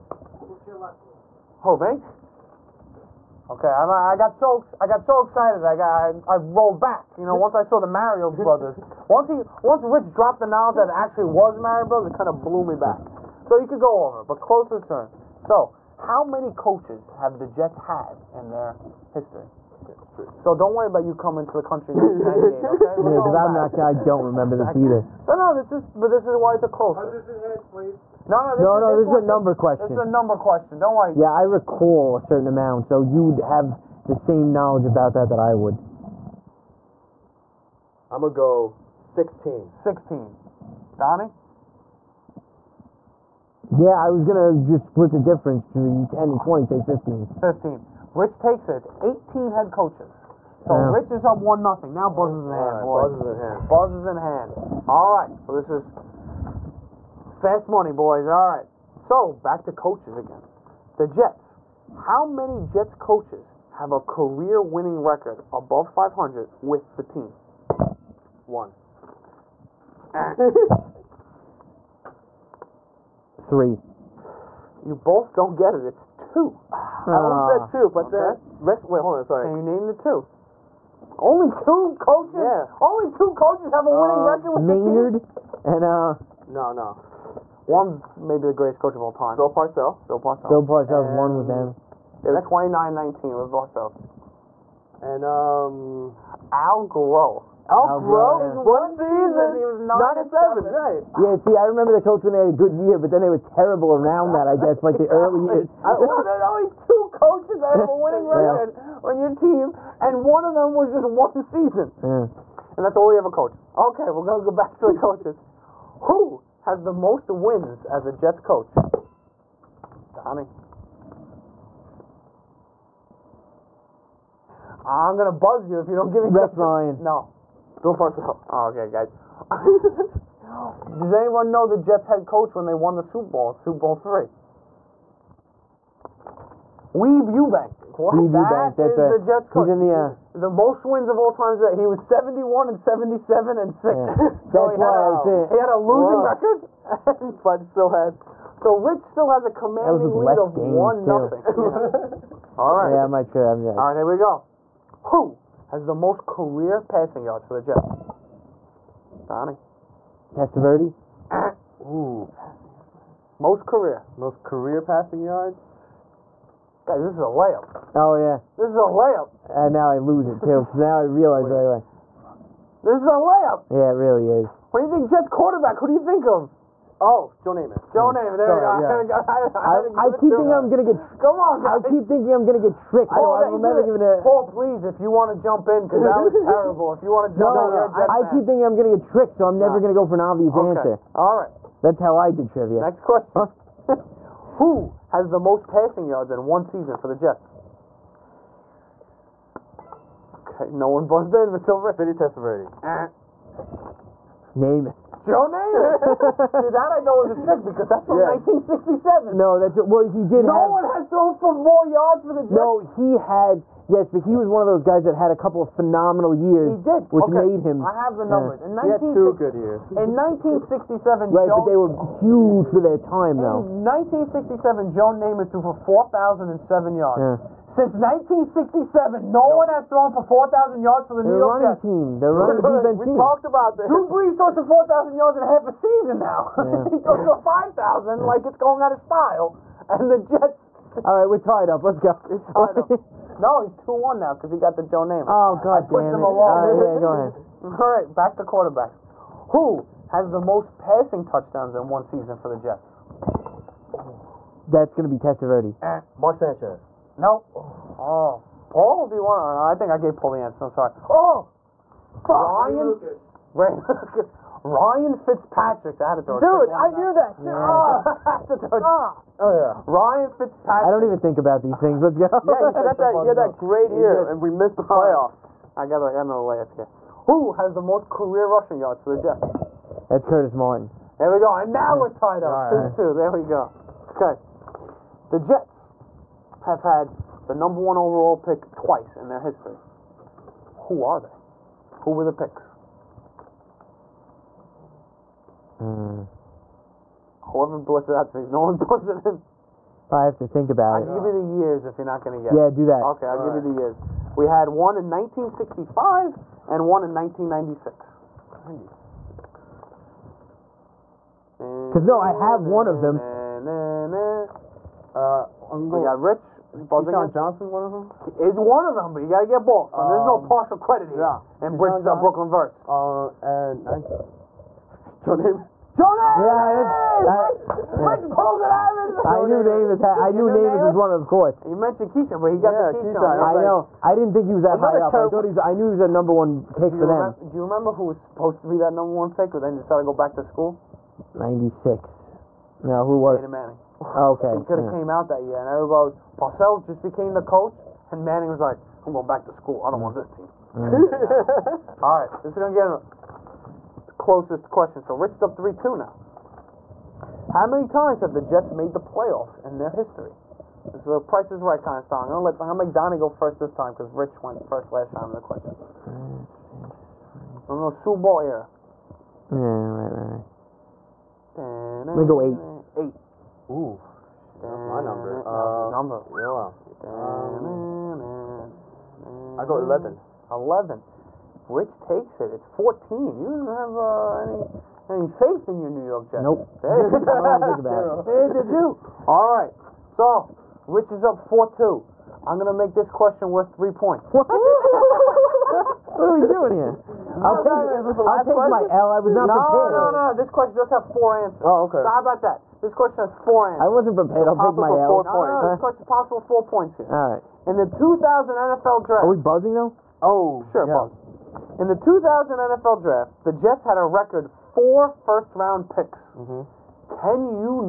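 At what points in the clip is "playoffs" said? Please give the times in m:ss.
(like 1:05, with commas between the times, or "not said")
4:34, 5:58.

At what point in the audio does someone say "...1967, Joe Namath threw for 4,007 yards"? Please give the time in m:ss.
3:43.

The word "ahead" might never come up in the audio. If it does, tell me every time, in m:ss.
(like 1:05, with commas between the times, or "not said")
4:07.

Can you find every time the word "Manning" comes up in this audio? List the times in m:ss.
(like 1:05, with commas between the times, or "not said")
5:43, 5:48.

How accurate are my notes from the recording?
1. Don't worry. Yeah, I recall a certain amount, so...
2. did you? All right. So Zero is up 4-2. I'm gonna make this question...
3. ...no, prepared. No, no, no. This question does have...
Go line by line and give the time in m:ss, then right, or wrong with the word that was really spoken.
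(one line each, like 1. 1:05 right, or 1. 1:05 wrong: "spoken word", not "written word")
1. 0:30 right
2. 6:28 wrong: "Rich", not "Zero"
3. 6:39 right.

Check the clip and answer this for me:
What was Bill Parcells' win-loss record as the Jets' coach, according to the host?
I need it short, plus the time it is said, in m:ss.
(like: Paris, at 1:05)
29-19, at 1:32.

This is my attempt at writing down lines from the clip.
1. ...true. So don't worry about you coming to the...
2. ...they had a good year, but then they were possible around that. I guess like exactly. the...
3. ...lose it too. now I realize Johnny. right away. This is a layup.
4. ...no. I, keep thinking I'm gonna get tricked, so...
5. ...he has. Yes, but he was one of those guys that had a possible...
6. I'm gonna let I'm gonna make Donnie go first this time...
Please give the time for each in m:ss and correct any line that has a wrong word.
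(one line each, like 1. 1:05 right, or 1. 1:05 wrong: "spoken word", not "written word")
1. 0:20 right
2. 1:42 wrong: "terrible", not "possible"
3. 2:49 wrong: "Wait", not "Johnny"
4. 3:07 right
5. 3:32 wrong: "couple", not "possible"
6. 6:02 right.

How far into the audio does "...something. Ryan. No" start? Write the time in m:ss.
2:06.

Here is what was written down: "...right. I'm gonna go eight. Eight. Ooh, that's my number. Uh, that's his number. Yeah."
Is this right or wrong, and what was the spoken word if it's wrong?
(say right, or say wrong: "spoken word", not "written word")
right.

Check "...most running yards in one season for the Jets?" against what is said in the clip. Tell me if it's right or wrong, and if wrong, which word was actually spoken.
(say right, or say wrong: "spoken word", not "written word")
wrong: "passing", not "running".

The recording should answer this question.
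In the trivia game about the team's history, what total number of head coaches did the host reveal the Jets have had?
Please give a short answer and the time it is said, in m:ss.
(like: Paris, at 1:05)
18, at 0:48.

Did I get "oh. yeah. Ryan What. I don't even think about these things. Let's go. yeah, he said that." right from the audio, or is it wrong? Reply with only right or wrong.
wrong.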